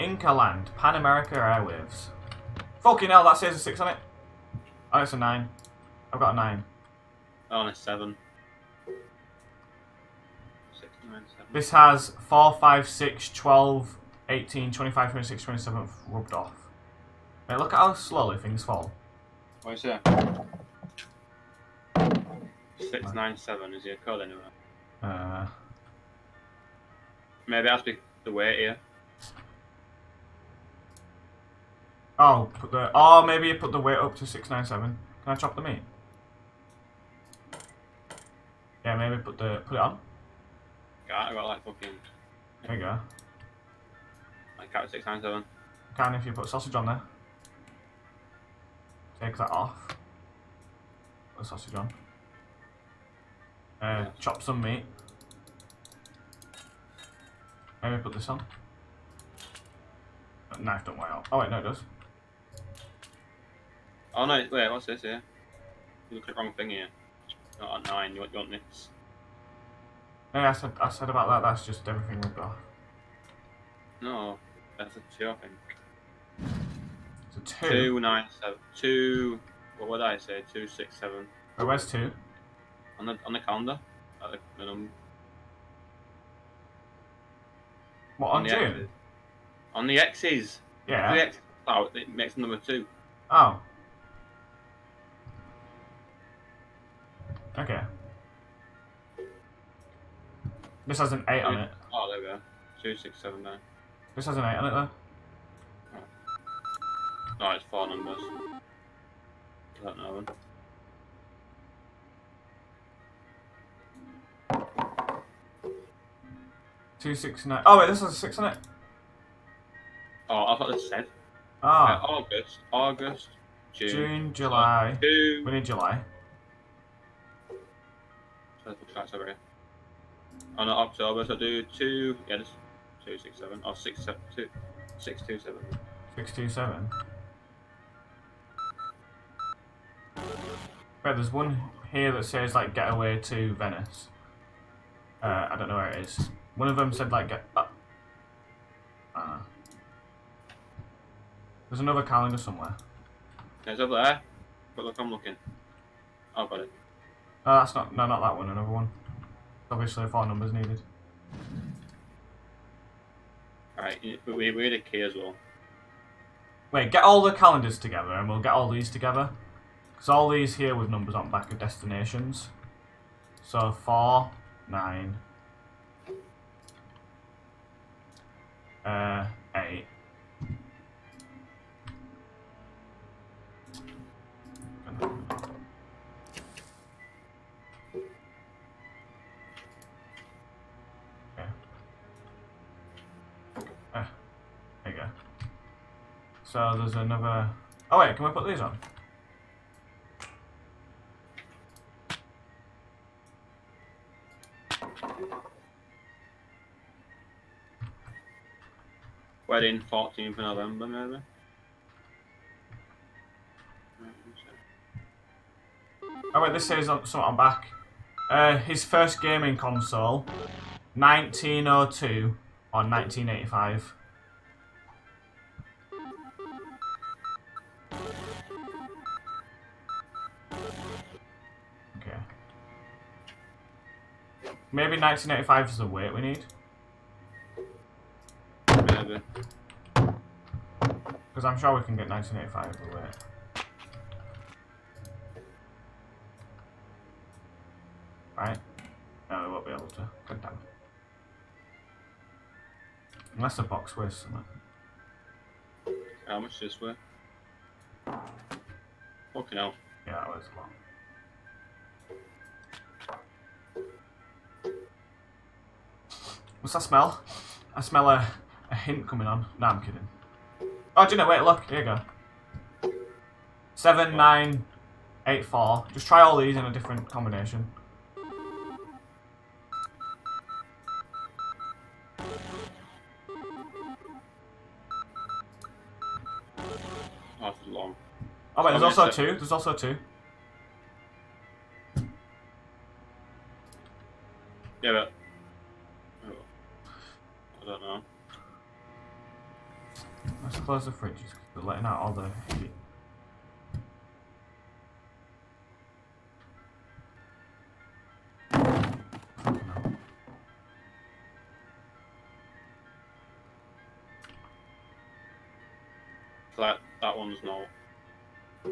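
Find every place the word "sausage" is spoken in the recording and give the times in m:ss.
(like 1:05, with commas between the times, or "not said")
0:46, 0:51.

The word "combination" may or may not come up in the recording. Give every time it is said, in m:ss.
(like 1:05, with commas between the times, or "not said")
4:37.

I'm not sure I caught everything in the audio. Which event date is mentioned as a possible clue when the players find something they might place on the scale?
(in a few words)
14th of November.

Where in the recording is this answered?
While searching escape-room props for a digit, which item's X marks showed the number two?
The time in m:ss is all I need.
1:28.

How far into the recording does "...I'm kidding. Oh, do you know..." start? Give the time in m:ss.
4:29.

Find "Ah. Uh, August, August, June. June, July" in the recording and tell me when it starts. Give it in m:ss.
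2:01.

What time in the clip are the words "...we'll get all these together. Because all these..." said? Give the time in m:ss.
2:48.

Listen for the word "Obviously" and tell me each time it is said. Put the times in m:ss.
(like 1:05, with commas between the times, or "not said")
2:39.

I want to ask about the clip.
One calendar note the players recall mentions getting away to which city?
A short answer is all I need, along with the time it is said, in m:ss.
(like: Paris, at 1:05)
Venice, at 2:23.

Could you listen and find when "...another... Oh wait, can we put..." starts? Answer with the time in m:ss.
3:16.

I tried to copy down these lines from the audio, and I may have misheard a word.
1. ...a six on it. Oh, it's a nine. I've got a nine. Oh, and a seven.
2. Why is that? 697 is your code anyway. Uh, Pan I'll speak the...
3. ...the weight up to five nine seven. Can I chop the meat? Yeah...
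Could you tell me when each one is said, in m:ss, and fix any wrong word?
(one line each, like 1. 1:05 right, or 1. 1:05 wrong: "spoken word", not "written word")
1. 0:03 right
2. 0:19 wrong: "Maybe", not "Pan"
3. 0:33 wrong: "six", not "five".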